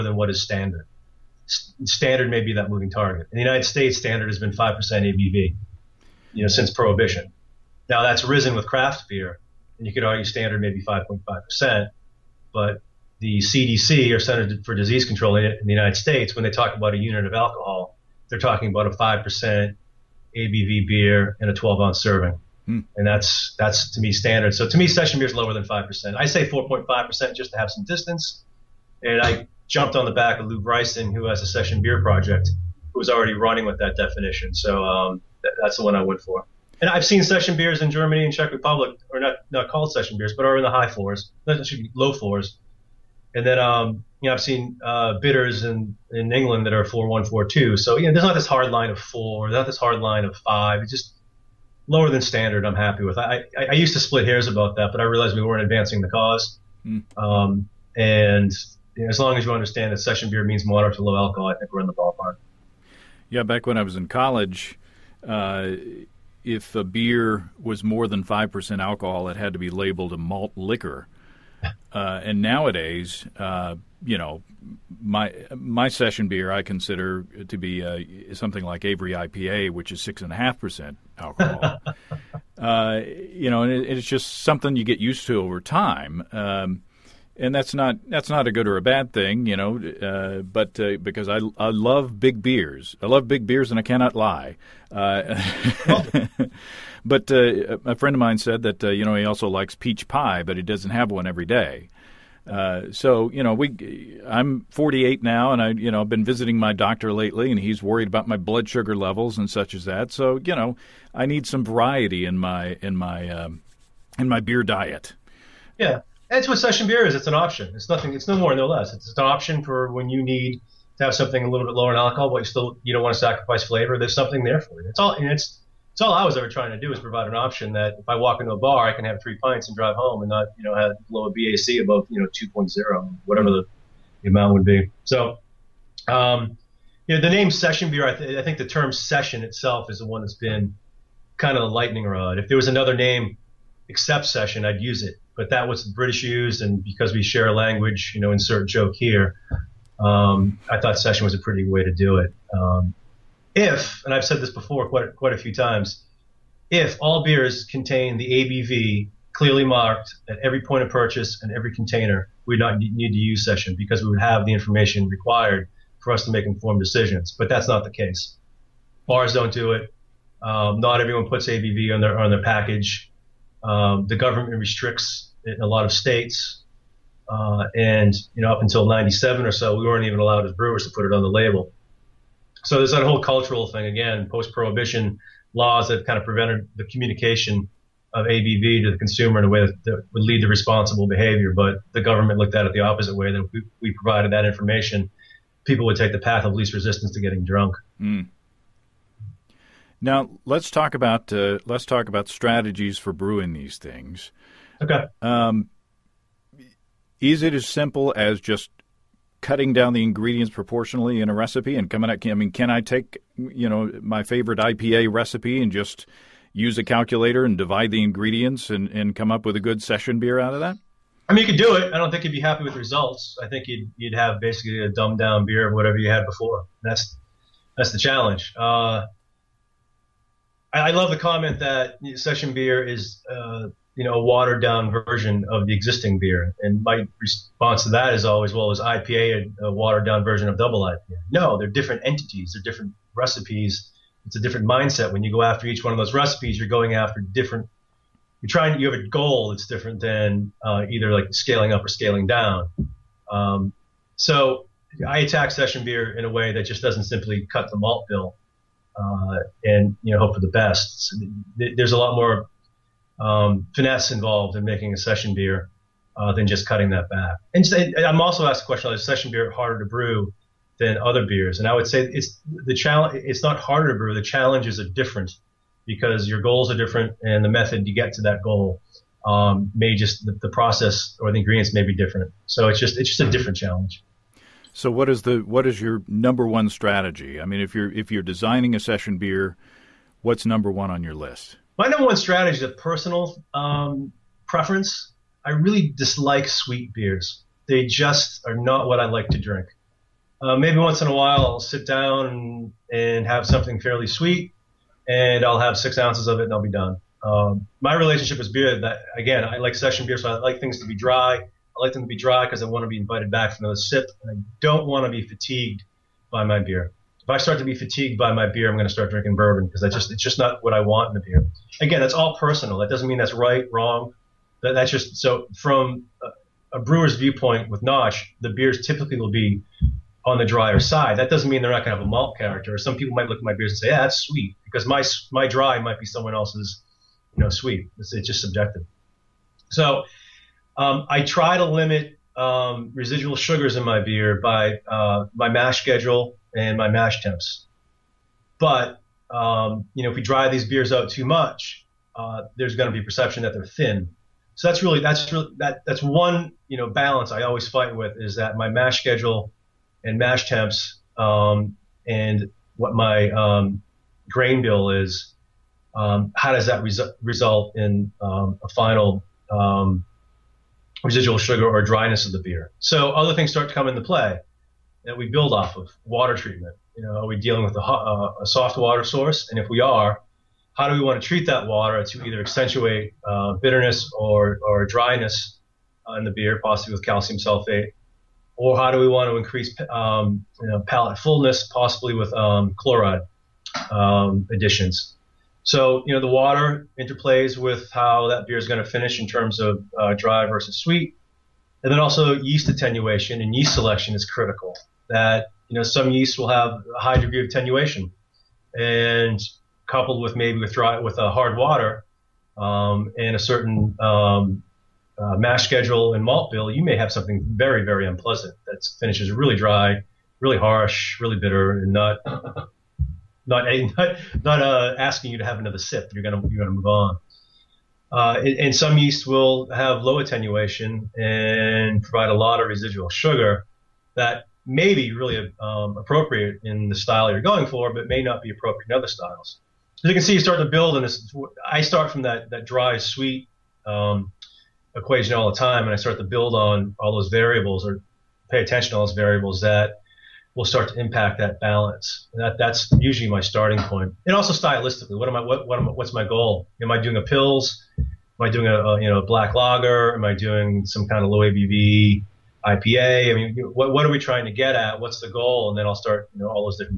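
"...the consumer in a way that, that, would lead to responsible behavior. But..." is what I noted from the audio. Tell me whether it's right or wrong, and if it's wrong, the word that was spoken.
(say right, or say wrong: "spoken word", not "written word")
right.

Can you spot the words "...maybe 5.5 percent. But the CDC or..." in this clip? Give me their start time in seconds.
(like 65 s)
10 s.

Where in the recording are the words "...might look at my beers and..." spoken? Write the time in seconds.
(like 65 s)
333 s.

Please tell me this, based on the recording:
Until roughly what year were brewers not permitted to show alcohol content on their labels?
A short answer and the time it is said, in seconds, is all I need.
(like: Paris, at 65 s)
1997, at 178 s.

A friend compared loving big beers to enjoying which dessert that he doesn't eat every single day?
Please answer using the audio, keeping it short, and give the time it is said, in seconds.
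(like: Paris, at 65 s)
peach pie, at 99 s.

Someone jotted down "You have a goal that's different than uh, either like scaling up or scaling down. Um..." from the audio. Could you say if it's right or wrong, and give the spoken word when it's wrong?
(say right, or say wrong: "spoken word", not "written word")
right.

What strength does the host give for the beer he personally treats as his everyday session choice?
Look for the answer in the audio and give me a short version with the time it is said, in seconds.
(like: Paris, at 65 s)
6.5 percent, at 80 s.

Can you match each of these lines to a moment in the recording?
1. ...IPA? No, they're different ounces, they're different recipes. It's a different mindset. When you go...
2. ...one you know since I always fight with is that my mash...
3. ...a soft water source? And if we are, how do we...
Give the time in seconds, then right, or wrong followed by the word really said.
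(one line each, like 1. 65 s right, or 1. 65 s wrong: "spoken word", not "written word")
1. 240 s wrong: "entities", not "ounces"
2. 356 s wrong: "balance", not "since"
3. 378 s right.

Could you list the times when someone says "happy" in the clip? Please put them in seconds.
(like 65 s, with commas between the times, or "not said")
52 s, 222 s.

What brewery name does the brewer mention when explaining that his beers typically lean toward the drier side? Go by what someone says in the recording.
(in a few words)
Notch.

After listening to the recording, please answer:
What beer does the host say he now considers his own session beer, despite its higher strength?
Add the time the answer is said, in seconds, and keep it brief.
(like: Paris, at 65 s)
Avery IPA, at 78 s.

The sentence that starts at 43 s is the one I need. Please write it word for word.
And then um, you know I've seen uh, bitters in in England that are four one four two.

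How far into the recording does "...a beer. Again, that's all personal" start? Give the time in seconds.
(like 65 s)
321 s.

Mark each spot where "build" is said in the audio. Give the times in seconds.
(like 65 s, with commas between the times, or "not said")
375 s, 440 s, 446 s.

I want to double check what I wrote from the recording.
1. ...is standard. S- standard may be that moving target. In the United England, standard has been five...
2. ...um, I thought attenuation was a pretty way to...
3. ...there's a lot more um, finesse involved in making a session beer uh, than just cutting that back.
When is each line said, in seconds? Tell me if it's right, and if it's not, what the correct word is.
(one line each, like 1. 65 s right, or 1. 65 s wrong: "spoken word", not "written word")
1. 0 s wrong: "States", not "England"
2. 149 s wrong: "session", not "attenuation"
3. 261 s right.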